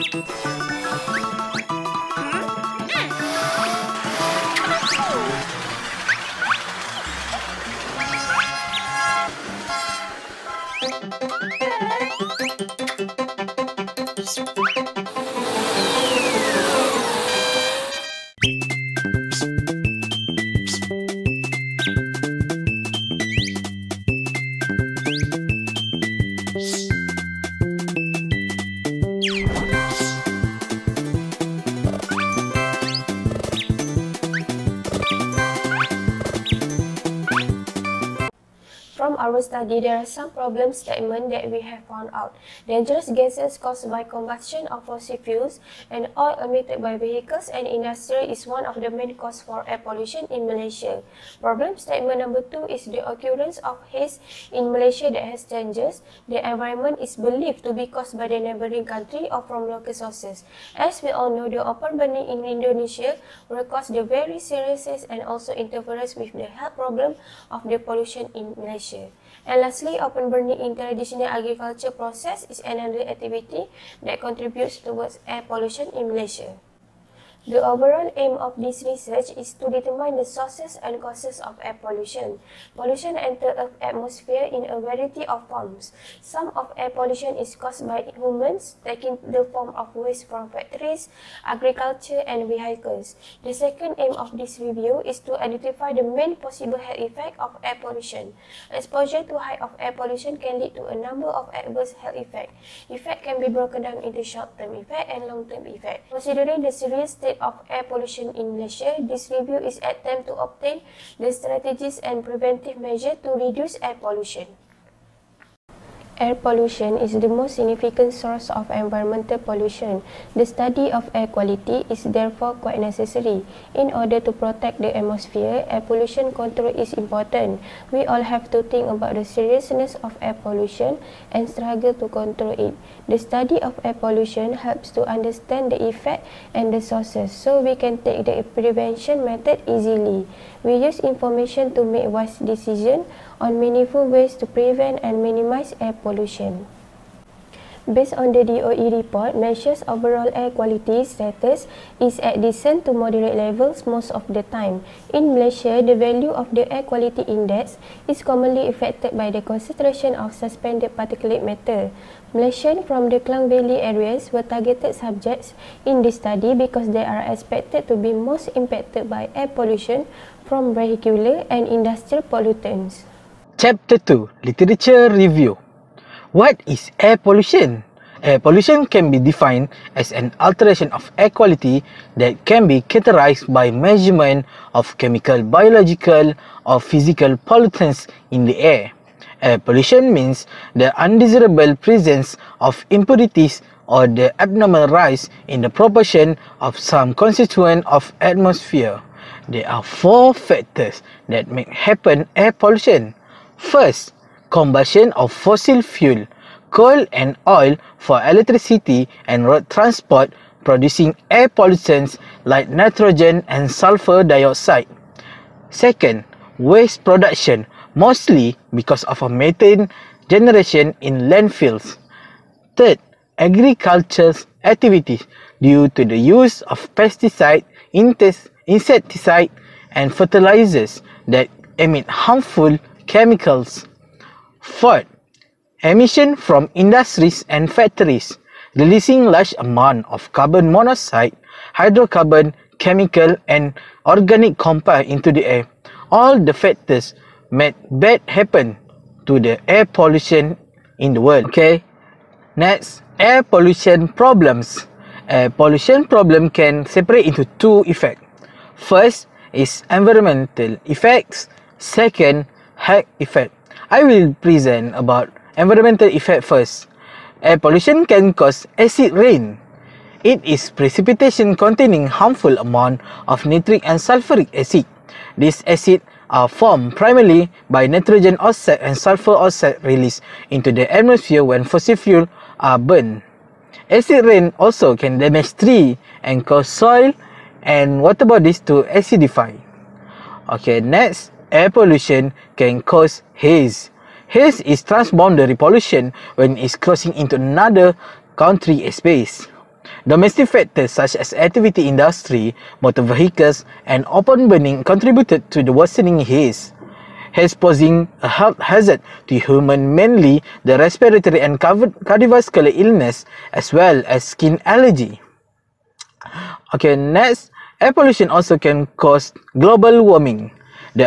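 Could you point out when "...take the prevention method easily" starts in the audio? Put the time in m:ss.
2:18.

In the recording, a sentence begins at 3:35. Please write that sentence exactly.
Second, waste production, mostly because of a methane generation in landfills.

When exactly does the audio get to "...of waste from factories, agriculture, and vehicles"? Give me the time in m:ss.
1:29.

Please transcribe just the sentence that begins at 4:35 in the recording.
This acid are formed primarily by nitrogen oxide and sulfur oxide released into the atmosphere when fossil fuel are burned.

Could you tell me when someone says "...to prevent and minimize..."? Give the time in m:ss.
2:24.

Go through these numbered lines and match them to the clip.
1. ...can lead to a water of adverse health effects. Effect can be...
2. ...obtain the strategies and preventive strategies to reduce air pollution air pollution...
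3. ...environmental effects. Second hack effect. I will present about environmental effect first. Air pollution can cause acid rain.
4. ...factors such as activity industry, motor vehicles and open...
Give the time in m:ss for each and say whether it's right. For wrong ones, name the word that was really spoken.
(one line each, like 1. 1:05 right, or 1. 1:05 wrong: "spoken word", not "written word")
1. 1:40 wrong: "number", not "water"
2. 1:50 wrong: "measures", not "strategies"
3. 4:19 right
4. 5:00 right.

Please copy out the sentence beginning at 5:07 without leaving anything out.
Haze posing a health hazard to human mainly the respiratory and cardiovascular illness as well as skin allergy.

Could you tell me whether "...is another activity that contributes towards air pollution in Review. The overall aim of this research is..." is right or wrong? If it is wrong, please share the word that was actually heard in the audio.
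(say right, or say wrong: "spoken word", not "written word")
wrong: "Malaysia", not "Review".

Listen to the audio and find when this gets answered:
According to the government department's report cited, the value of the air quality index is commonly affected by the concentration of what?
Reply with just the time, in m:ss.
2:40.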